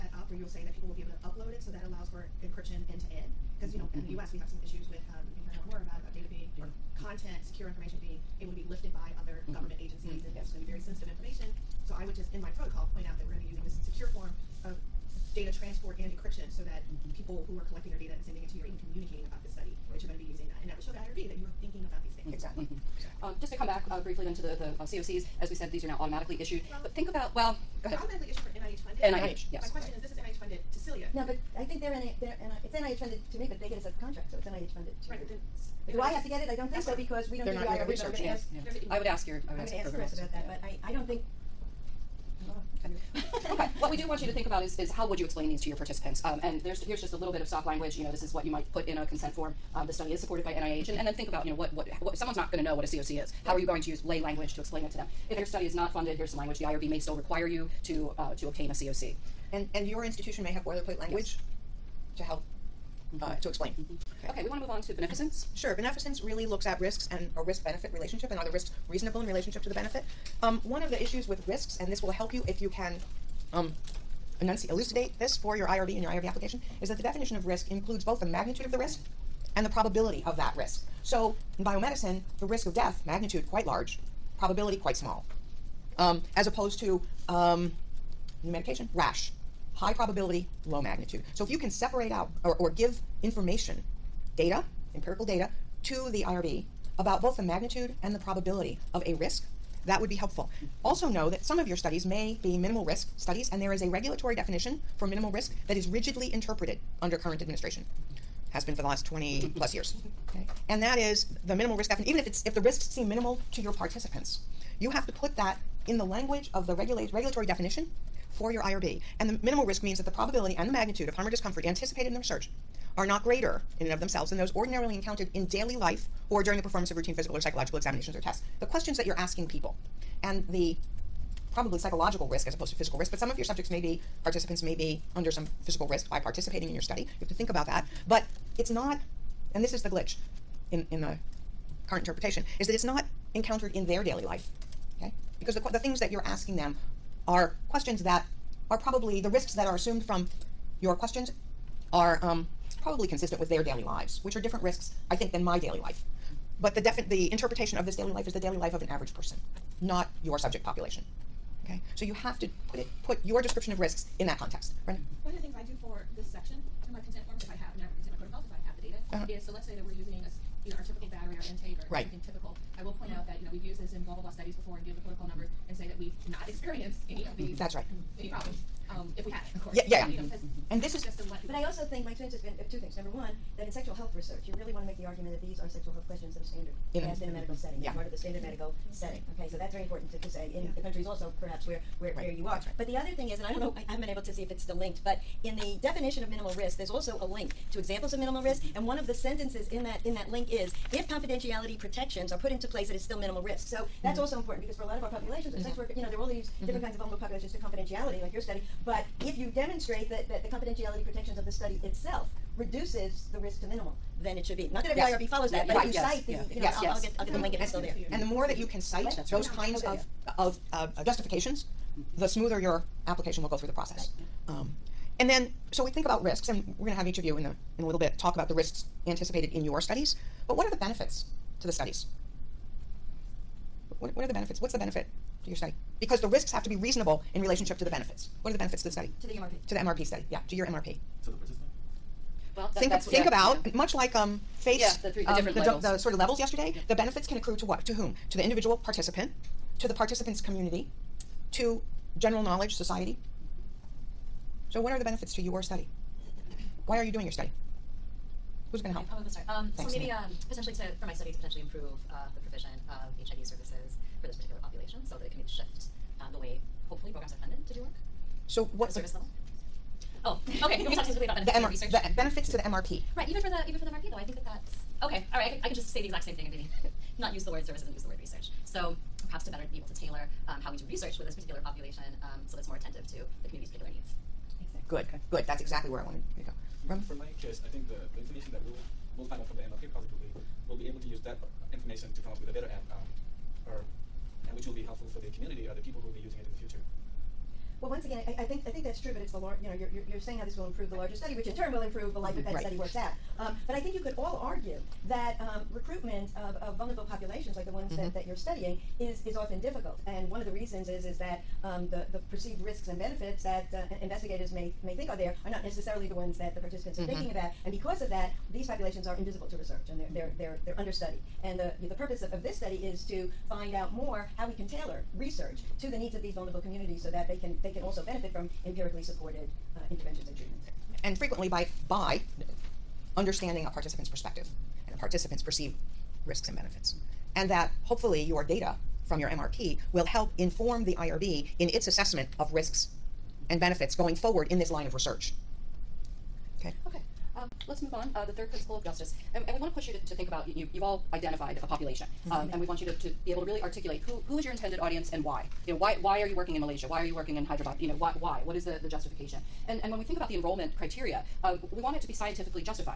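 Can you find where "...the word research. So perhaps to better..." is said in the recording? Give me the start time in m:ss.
4:38.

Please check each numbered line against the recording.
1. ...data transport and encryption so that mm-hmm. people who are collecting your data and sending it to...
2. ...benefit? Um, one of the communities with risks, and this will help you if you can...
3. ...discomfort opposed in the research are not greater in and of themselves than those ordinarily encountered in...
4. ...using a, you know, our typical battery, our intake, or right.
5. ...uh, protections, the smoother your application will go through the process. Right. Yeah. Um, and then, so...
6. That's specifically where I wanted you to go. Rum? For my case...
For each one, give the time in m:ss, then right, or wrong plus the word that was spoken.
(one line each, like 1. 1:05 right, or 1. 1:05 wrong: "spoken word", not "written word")
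1. 0:15 right
2. 1:09 wrong: "issues", not "communities"
3. 2:01 wrong: "anticipated", not "opposed"
4. 2:49 right
5. 3:40 wrong: "justifications", not "protections"
6. 4:45 wrong: "exactly", not "specifically".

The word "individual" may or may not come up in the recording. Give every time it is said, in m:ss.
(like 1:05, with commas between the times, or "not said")
4:08.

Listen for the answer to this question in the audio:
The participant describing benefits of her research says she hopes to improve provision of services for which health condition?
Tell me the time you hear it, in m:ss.
4:23.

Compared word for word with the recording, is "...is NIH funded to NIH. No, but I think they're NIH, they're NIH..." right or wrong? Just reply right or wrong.
wrong.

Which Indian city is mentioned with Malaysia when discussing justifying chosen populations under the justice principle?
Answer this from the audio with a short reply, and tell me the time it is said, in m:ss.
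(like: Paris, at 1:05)
Hyderabad, at 5:57.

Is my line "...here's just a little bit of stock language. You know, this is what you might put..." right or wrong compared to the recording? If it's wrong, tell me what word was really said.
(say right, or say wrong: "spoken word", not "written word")
right.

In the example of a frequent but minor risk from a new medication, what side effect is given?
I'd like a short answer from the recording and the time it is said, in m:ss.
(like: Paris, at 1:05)
rash, at 1:28.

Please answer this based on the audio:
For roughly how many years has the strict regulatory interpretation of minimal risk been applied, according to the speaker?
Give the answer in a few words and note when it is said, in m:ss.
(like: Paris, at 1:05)
20 plus years, at 1:49.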